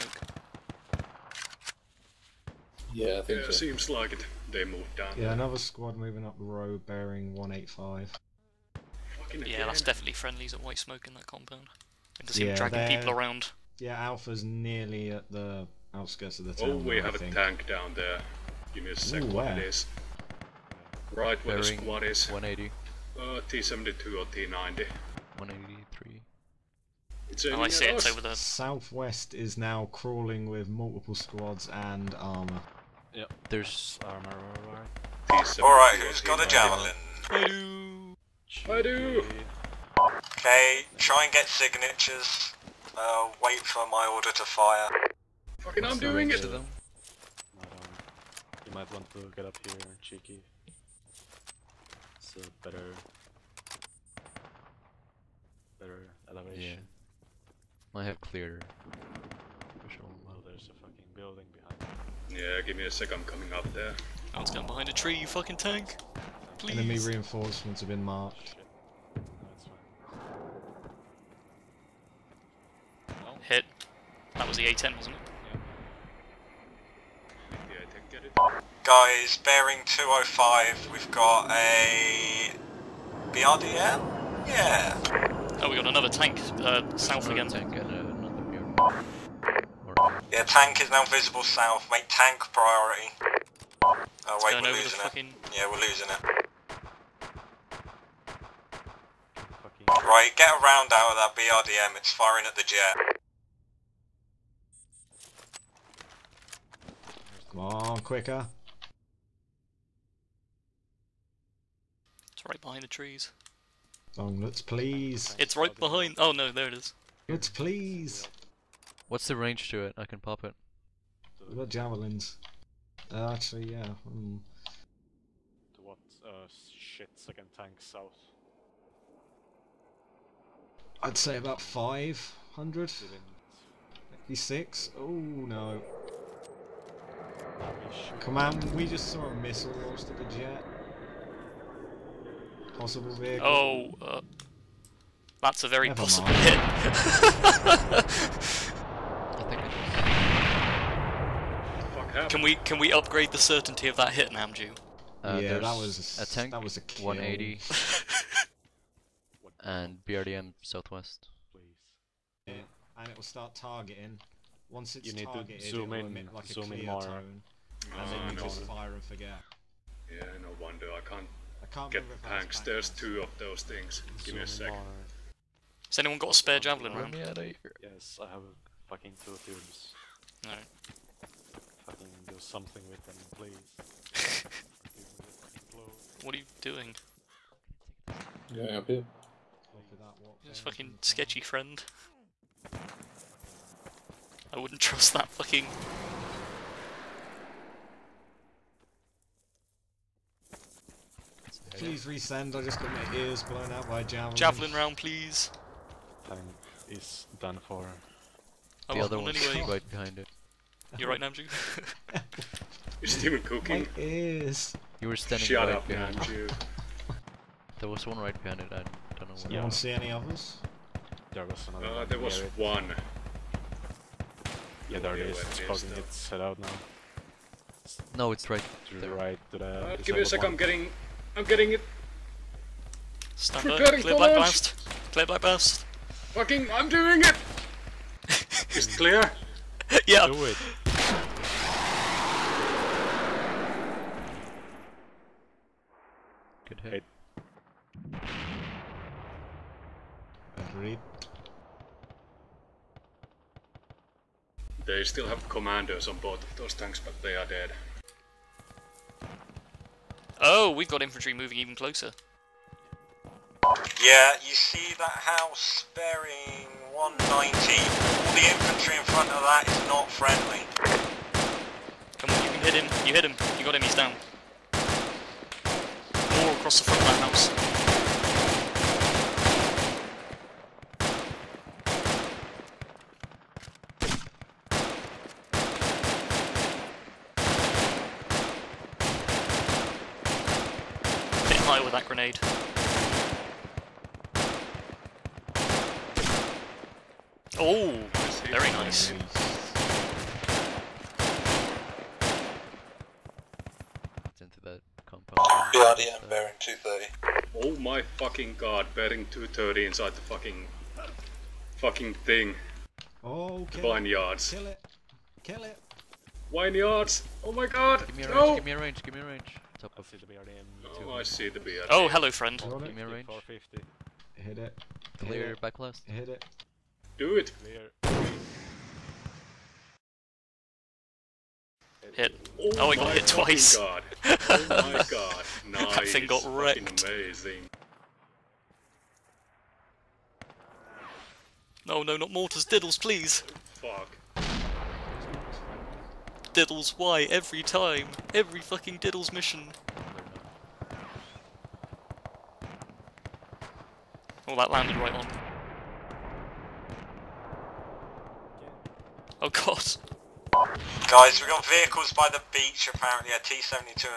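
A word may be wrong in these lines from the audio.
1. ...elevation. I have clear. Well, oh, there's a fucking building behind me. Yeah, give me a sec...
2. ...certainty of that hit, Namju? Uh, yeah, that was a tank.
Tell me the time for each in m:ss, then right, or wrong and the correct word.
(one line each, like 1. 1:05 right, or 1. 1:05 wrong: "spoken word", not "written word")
1. 0:56 right
2. 2:33 right.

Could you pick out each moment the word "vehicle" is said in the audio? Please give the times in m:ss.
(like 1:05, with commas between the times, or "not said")
2:23, 6:01.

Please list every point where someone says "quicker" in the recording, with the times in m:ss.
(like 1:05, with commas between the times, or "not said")
1:48.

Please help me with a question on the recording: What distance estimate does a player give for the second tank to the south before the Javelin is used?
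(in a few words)
500.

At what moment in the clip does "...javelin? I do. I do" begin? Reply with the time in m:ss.
0:36.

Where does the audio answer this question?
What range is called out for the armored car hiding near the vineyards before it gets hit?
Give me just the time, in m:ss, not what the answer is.
5:23.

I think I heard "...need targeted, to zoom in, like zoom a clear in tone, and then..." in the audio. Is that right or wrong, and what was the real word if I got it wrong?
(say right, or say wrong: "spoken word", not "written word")
right.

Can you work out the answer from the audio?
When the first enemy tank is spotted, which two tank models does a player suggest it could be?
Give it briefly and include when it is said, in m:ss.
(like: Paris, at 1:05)
T72 or T90, at 0:23.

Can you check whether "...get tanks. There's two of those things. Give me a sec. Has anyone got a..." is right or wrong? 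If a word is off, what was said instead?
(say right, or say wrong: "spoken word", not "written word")
right.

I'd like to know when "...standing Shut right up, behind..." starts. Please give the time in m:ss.
3:35.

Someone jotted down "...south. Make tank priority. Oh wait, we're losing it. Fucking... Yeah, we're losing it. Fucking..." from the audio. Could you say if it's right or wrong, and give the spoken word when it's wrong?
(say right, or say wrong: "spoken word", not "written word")
right.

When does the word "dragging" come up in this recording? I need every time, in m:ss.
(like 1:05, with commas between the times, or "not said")
0:12.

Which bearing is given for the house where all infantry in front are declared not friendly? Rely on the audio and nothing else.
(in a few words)
190.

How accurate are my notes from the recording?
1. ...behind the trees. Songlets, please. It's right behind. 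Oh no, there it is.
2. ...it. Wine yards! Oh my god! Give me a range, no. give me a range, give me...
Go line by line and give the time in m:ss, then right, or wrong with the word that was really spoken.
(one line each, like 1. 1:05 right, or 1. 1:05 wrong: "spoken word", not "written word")
1. 1:52 right
2. 5:15 right.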